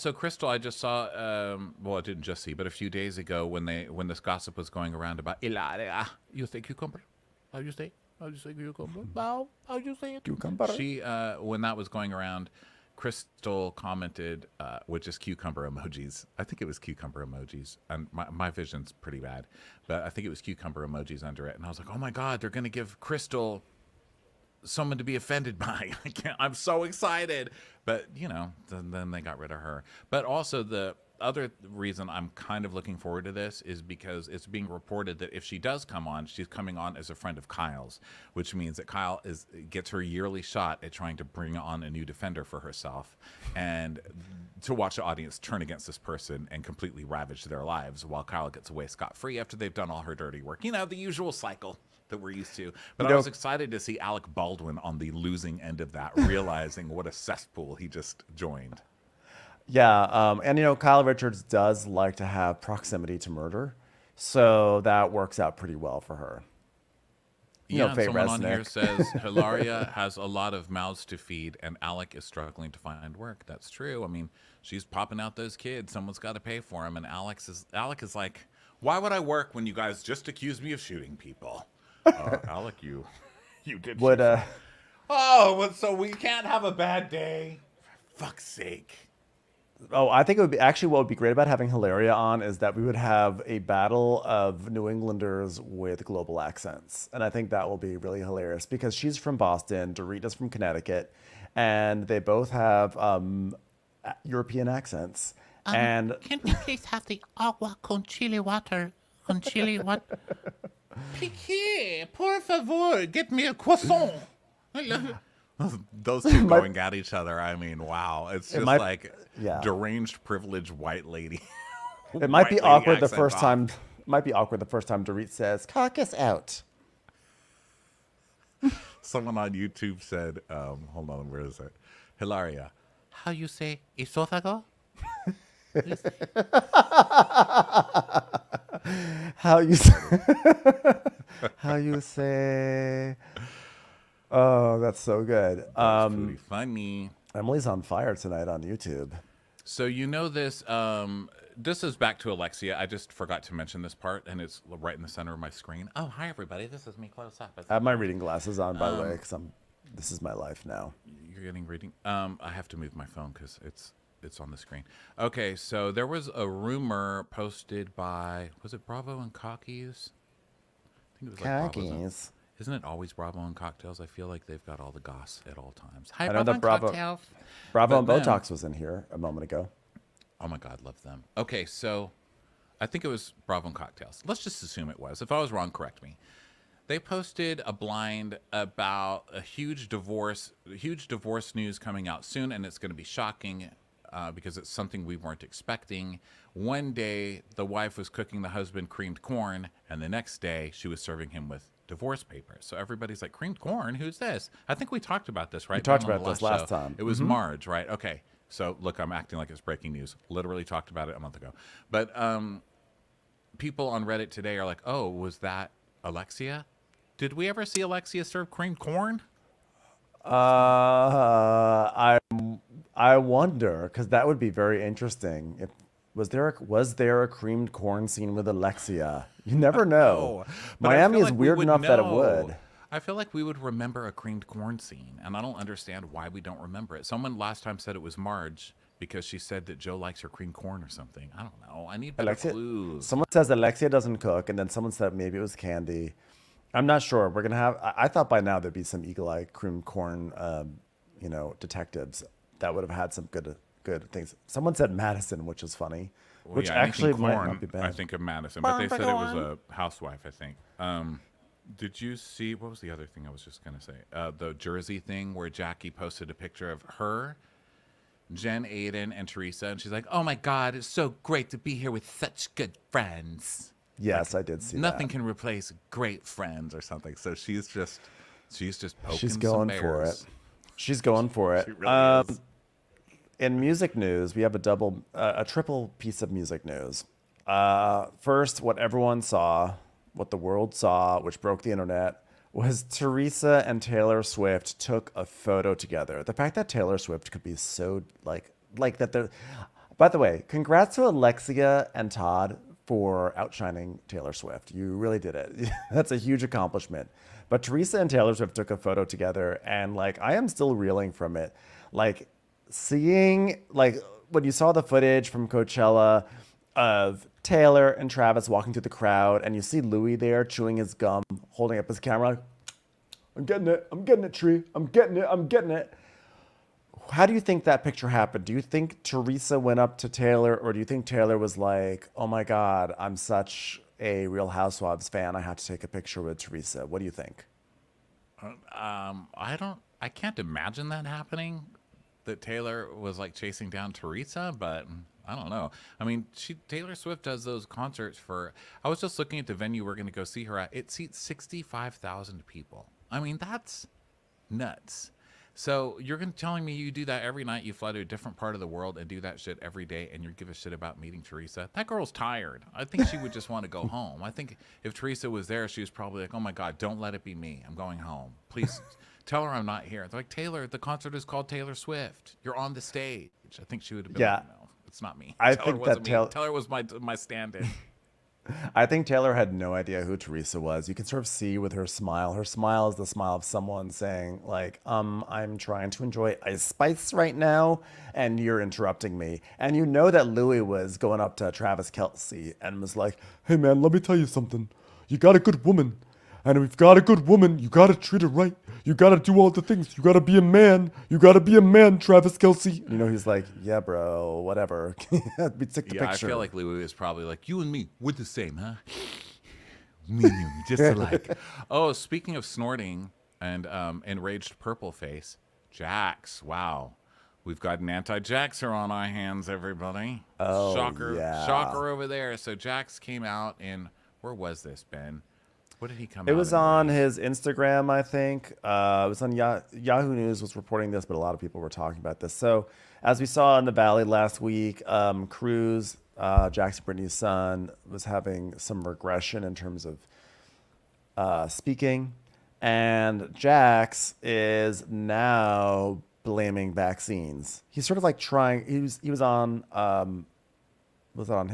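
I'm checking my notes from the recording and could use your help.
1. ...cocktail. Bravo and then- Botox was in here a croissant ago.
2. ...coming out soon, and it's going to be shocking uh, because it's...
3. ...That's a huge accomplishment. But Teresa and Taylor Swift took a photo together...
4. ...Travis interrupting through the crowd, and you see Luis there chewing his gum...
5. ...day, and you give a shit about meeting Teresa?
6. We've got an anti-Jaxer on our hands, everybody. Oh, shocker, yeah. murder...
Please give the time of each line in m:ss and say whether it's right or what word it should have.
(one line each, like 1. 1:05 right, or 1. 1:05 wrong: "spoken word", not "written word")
1. 2:56 wrong: "moment", not "croissant"
2. 3:11 right
3. 5:05 right
4. 5:18 wrong: "walking", not "interrupting"
5. 5:59 right
6. 6:57 wrong: "shocker", not "murder".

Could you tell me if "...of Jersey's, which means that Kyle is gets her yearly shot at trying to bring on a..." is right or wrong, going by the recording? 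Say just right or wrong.
wrong.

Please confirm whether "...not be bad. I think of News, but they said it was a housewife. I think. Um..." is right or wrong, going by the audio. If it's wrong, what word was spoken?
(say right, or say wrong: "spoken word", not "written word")
wrong: "Madison", not "News".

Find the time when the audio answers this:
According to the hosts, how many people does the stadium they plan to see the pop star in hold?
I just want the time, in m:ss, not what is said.
5:51.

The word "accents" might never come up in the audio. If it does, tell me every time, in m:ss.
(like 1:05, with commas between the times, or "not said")
1:36, 1:44.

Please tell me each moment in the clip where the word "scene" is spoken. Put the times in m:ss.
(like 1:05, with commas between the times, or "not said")
3:48, 3:54.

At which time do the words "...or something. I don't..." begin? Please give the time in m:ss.
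4:00.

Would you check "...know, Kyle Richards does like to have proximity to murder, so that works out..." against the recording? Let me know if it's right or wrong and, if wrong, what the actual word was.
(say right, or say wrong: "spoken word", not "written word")
right.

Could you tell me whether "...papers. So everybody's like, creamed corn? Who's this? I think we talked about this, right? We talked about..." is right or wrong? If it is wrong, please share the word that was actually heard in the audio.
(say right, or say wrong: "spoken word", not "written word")
right.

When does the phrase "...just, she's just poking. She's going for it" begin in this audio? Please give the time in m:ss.
4:37.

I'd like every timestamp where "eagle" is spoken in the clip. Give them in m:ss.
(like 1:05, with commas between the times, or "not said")
4:09.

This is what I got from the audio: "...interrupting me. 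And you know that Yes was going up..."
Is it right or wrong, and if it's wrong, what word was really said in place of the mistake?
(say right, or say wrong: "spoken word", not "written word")
wrong: "Luis", not "Yes".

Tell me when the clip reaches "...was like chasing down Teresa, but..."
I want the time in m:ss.
5:42.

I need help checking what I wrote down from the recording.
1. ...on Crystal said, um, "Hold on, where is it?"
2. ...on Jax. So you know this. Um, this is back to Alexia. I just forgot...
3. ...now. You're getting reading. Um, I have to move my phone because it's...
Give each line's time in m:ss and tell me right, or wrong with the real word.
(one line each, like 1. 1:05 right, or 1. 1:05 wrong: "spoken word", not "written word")
1. 2:09 wrong: "YouTube", not "Crystal"
2. 2:28 wrong: "YouTube", not "Jax"
3. 2:40 right.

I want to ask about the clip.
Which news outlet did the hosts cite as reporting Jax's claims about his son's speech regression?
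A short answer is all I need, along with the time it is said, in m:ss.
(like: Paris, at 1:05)
Yahoo News, at 7:09.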